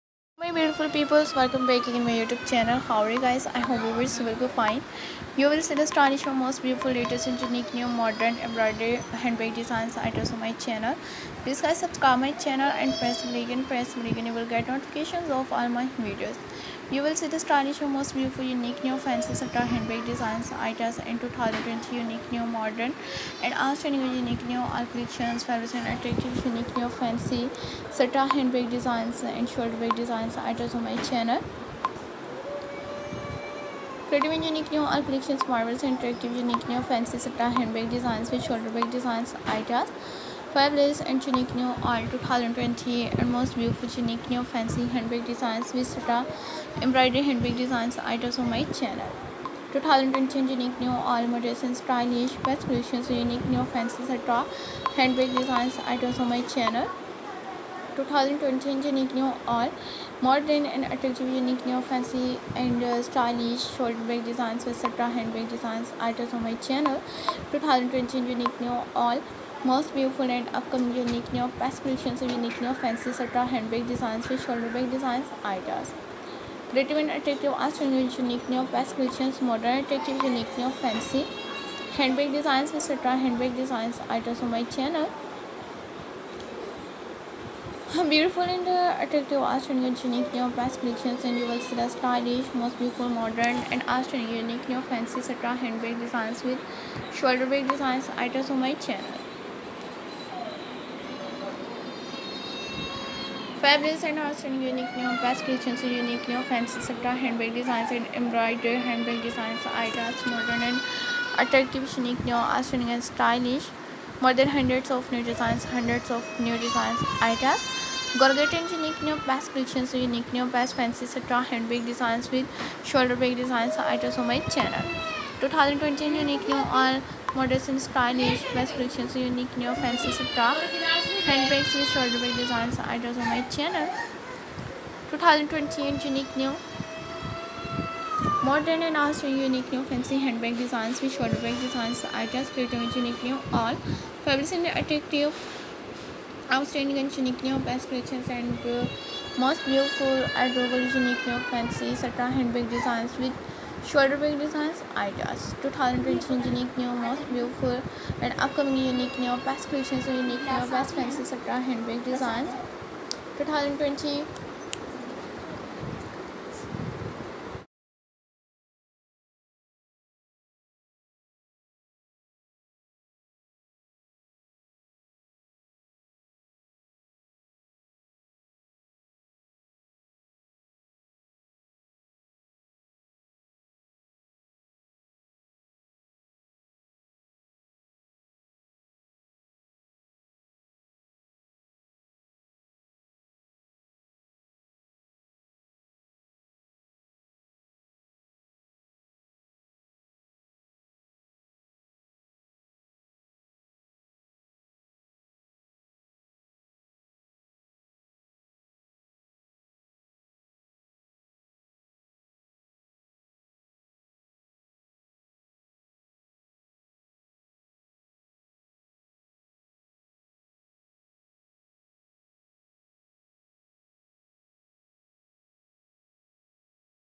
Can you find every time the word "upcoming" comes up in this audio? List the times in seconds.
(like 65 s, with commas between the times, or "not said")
70 s, 158 s.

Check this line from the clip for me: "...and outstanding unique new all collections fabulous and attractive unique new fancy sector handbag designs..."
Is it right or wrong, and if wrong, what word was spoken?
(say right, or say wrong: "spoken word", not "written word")
right.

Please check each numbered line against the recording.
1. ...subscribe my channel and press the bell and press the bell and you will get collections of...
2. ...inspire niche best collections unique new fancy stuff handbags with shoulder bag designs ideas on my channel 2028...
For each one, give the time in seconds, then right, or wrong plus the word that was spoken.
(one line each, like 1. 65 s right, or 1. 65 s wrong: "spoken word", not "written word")
1. 11 s wrong: "notifications", not "collections"
2. 127 s right.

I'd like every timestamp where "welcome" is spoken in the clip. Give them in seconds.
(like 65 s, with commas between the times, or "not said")
1 s.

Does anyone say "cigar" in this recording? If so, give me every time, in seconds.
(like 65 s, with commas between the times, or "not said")
not said.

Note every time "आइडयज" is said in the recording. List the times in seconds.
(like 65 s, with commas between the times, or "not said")
109 s, 117 s.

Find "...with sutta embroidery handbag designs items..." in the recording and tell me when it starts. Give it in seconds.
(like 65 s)
45 s.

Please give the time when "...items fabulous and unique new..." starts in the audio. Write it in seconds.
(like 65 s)
39 s.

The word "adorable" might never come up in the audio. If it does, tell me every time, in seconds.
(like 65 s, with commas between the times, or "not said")
150 s.